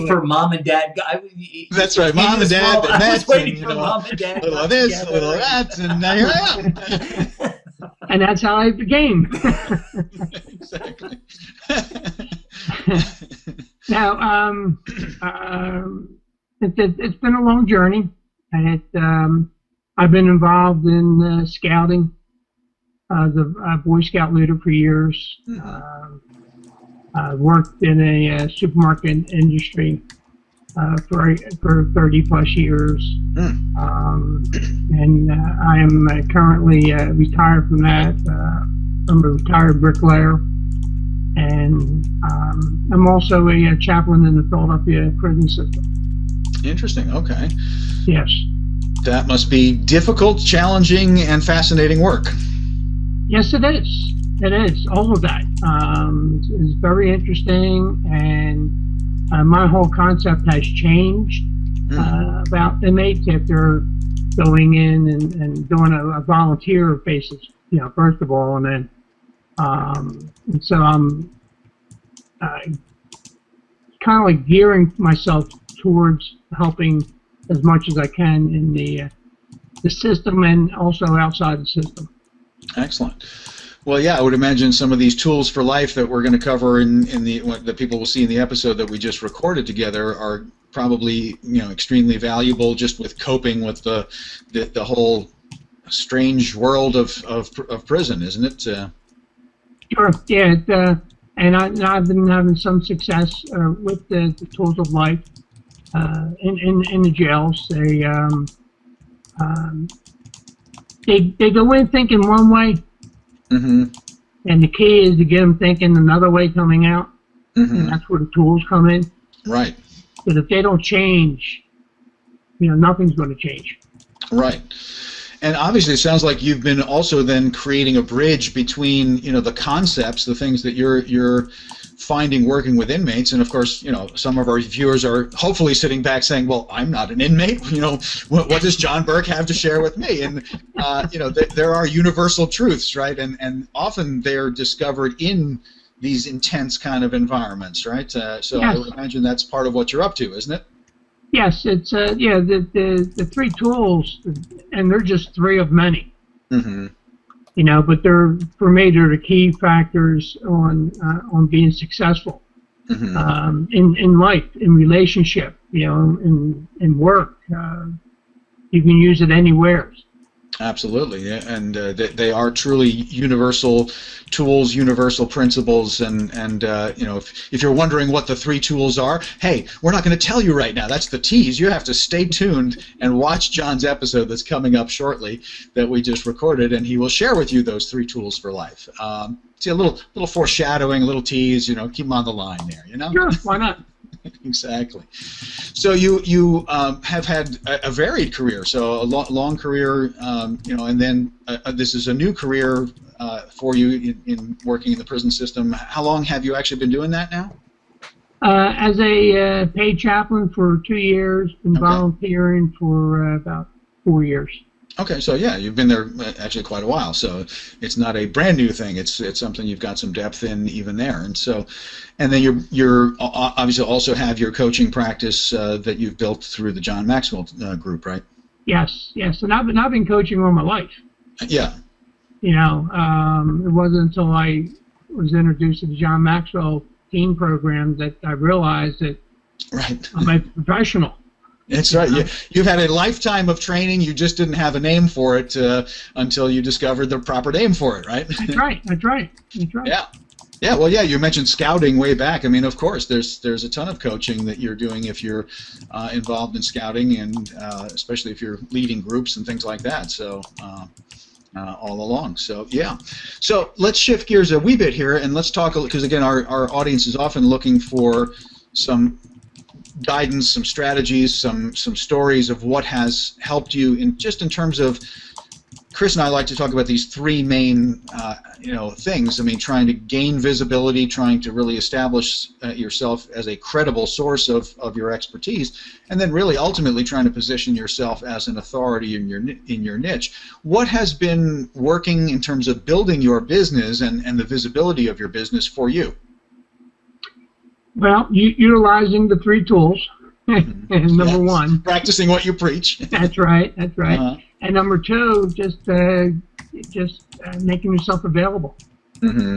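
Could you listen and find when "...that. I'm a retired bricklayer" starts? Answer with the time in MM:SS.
00:37.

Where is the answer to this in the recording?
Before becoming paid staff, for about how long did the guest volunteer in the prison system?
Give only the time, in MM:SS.
03:34.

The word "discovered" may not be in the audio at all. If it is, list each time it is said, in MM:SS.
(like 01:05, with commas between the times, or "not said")
02:24, 04:06.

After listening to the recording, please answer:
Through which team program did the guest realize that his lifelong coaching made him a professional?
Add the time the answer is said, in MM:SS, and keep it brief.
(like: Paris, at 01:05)
John Maxwell team, at 03:55.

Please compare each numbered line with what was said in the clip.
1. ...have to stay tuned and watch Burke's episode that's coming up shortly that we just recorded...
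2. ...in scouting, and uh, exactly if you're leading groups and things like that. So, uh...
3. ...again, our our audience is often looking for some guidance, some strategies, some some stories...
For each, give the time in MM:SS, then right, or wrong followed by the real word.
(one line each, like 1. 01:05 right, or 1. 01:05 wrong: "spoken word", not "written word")
1. 03:01 wrong: "John", not "Burke"
2. 04:16 wrong: "especially", not "exactly"
3. 04:26 right.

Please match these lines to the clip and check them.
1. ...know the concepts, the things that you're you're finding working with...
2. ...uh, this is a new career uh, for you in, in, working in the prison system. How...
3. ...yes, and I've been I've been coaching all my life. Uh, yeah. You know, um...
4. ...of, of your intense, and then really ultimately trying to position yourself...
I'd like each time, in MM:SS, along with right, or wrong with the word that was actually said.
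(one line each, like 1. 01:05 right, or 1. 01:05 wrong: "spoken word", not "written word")
1. 02:09 right
2. 03:21 right
3. 03:49 right
4. 04:44 wrong: "expertise", not "intense".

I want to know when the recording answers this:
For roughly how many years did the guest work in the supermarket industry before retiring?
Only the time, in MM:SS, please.
00:31.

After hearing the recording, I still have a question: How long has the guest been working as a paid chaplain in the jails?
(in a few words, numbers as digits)
2 years.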